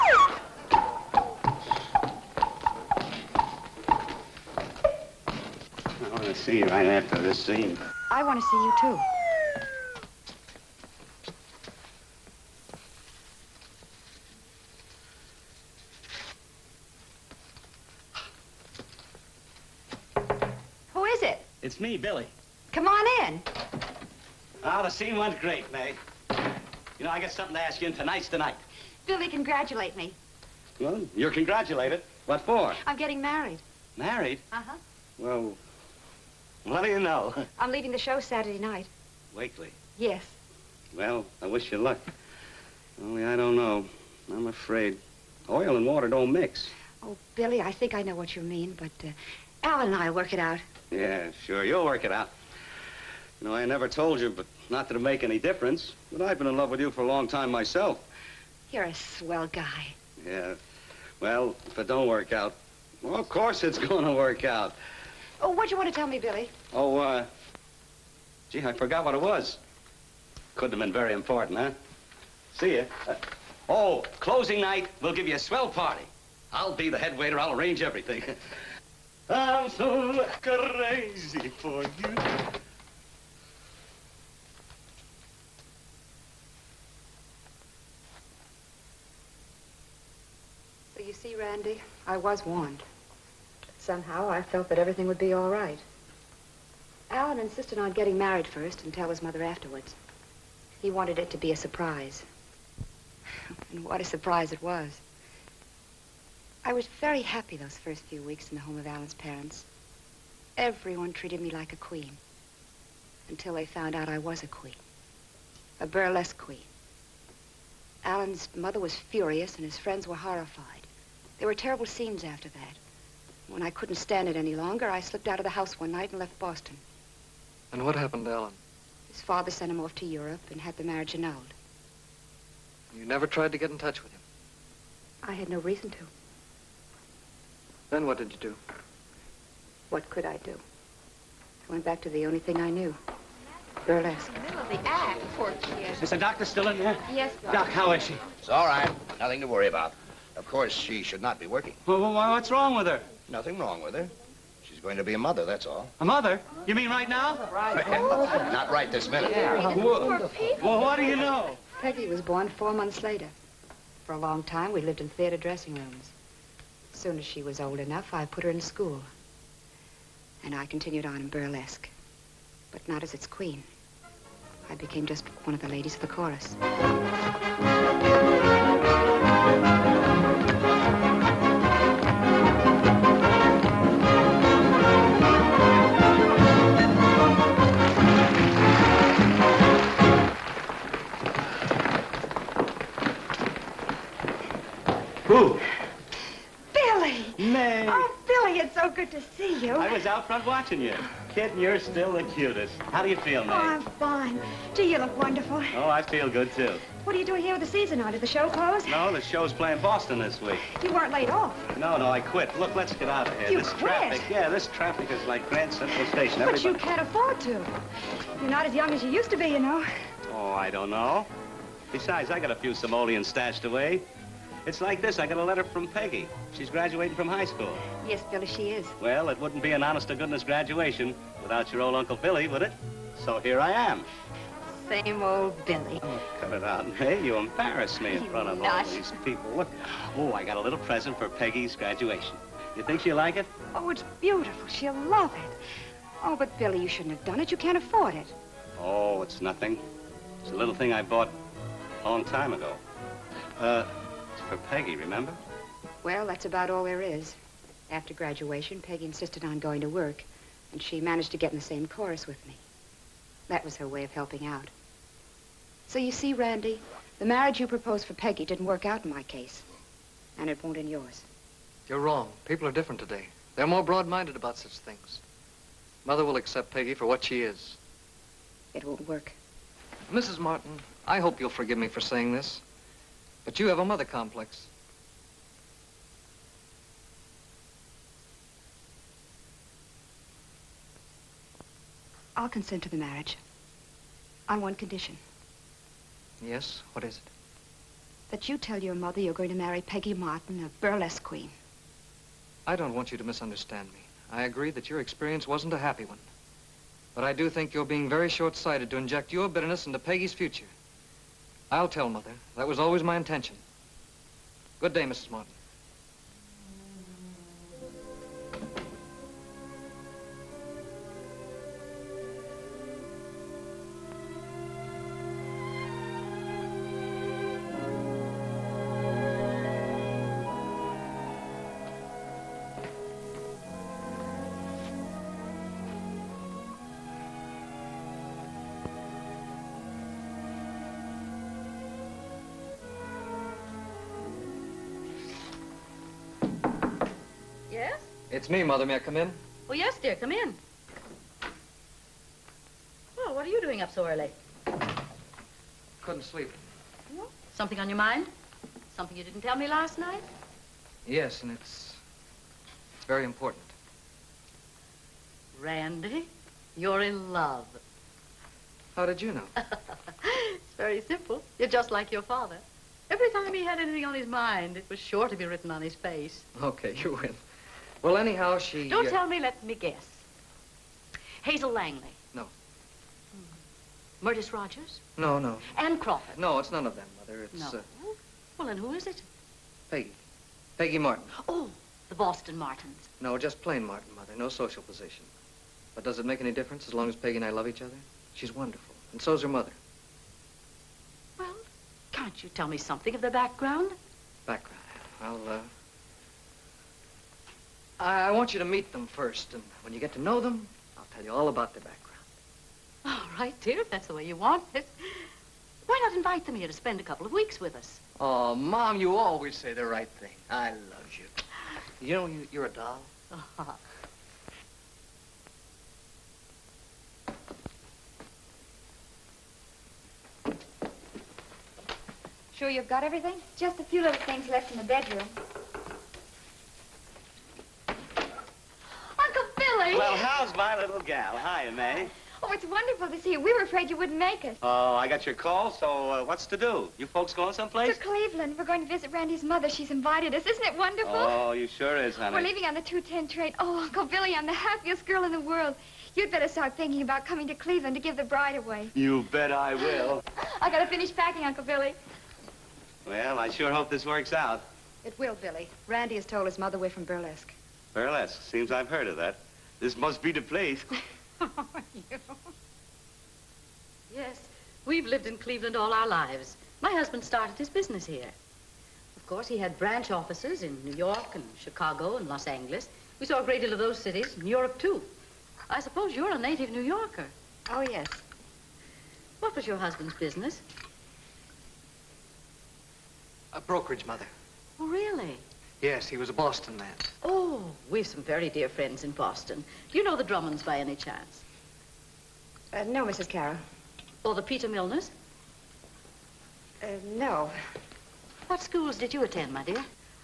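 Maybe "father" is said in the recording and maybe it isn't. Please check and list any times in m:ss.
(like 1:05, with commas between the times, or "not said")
2:09, 6:12.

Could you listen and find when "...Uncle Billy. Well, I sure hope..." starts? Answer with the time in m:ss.
7:41.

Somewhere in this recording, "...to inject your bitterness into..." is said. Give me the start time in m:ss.
5:08.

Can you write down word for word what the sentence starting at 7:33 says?
Oh, Uncle Billy, I'm the happiest girl in the world.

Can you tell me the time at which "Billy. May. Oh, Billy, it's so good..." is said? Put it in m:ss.
3:16.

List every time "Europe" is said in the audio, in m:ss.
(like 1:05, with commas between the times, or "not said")
2:10, 8:04.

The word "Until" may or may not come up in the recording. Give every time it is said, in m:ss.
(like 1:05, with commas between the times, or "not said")
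1:53.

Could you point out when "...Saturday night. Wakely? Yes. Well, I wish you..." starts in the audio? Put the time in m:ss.
0:38.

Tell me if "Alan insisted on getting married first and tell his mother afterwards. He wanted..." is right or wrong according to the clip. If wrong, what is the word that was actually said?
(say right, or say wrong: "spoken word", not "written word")
right.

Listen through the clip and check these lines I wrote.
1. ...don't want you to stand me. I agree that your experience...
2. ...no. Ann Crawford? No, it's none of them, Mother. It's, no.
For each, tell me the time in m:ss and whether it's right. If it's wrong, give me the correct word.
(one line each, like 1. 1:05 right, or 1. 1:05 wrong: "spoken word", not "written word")
1. 5:02 wrong: "misunderstand", not "stand"
2. 6:25 right.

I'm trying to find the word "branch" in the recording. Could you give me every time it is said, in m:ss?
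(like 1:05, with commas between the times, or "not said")
7:59.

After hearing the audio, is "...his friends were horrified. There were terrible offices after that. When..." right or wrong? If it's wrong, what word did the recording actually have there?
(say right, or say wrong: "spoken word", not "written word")
wrong: "scenes", not "offices".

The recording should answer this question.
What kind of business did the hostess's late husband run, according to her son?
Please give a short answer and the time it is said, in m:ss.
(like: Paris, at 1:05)
A brokerage, at 8:13.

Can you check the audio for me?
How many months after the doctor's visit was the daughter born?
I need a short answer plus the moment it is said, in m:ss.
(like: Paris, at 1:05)
4, at 2:42.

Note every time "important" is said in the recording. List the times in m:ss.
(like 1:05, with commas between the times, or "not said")
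1:11, 6:03.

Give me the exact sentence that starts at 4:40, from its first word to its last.
Martin, I hope you'll forgive me for saying this.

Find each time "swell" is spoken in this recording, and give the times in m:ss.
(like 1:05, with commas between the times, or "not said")
0:58, 1:15.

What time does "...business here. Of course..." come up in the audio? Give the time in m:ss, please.
7:57.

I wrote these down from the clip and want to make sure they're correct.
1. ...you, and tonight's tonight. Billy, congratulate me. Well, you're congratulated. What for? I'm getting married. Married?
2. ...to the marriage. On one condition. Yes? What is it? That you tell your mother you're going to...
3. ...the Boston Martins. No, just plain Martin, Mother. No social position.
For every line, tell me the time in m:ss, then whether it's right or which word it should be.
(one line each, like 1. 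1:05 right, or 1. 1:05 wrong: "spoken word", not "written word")
1. 0:27 right
2. 4:52 right
3. 6:32 right.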